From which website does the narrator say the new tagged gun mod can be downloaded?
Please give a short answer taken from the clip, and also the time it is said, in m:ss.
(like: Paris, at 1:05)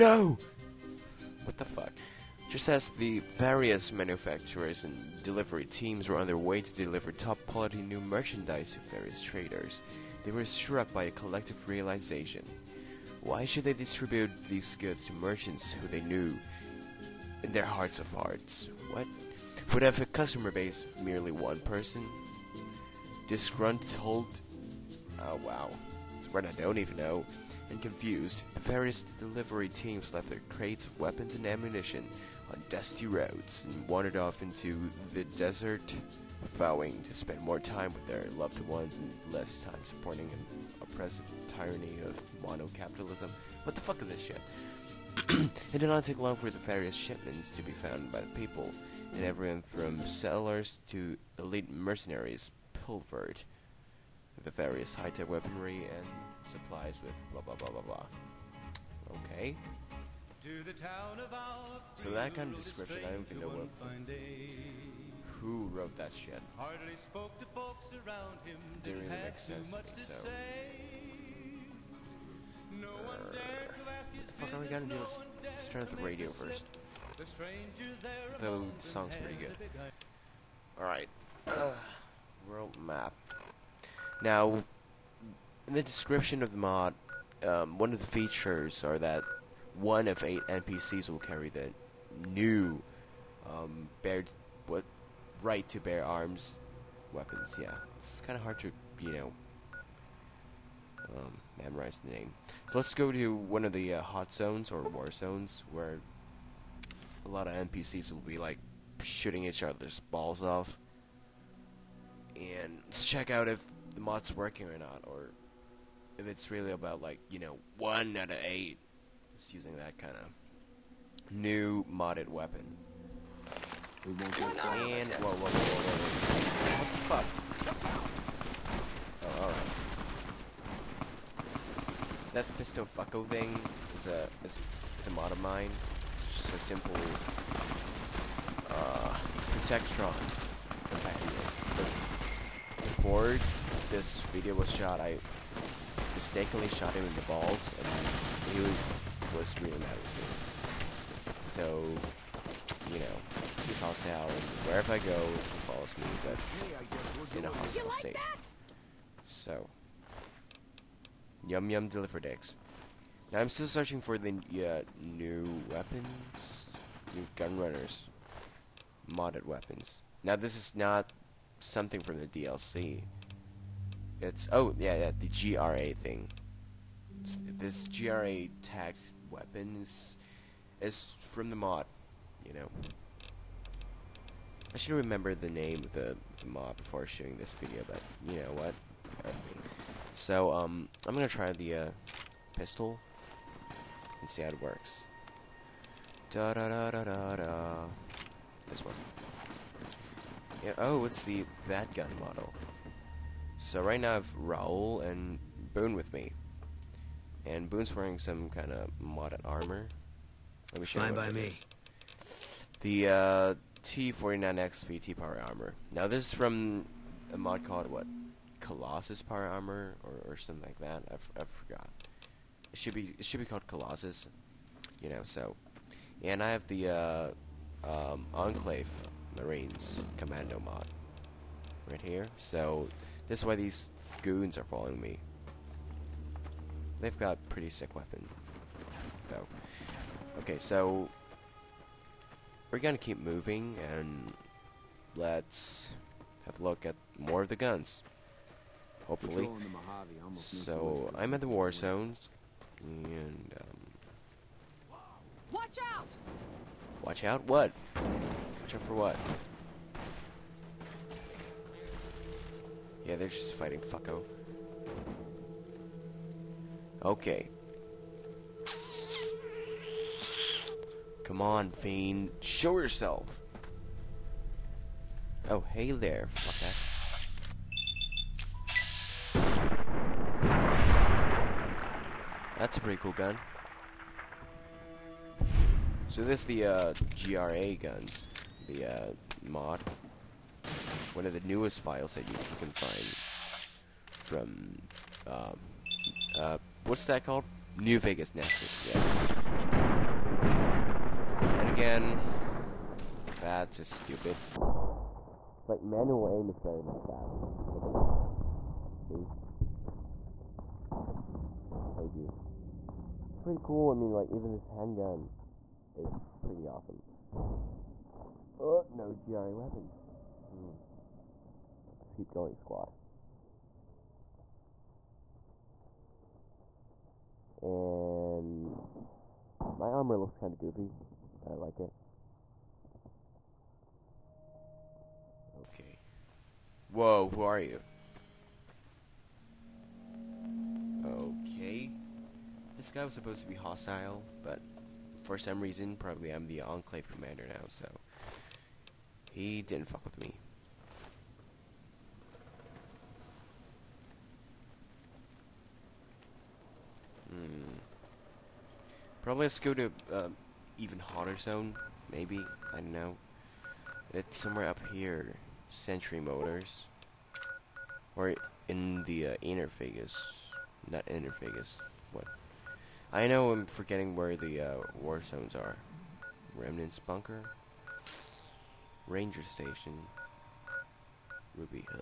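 New Vegas Nexus, at 4:57.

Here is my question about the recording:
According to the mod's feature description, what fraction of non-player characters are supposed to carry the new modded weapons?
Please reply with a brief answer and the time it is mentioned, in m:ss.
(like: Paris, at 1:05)
1 out of 8, at 1:29.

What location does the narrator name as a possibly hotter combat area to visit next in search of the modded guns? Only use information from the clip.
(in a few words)
Century Motors.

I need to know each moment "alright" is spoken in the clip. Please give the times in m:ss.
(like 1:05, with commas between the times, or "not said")
1:20, 2:12.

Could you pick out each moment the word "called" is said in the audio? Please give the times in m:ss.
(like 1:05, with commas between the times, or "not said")
3:37, 3:43, 4:57.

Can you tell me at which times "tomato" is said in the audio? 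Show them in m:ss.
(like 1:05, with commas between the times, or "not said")
not said.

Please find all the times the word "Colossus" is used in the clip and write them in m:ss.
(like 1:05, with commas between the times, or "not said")
3:38, 3:43.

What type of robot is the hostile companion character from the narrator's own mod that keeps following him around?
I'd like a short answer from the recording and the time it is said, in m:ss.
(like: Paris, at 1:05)
Protectron, at 2:19.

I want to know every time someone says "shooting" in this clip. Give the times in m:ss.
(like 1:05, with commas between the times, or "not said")
1:49, 3:07.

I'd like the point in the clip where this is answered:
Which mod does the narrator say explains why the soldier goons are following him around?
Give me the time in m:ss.
3:48.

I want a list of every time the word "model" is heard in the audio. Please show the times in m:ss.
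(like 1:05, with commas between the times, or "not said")
3:22.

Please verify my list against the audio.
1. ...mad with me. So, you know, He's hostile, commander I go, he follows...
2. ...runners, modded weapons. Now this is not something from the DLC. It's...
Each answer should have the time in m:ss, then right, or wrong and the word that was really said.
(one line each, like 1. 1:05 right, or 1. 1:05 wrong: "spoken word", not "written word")
1. 2:29 wrong: "wherever", not "commander"
2. 2:47 right.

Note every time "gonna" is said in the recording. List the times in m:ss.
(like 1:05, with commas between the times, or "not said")
1:14, 3:11, 4:02.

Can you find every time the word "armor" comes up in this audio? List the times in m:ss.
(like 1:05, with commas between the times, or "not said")
3:29, 3:35, 3:39, 5:29.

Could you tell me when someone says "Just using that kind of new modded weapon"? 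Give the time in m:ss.
1:59.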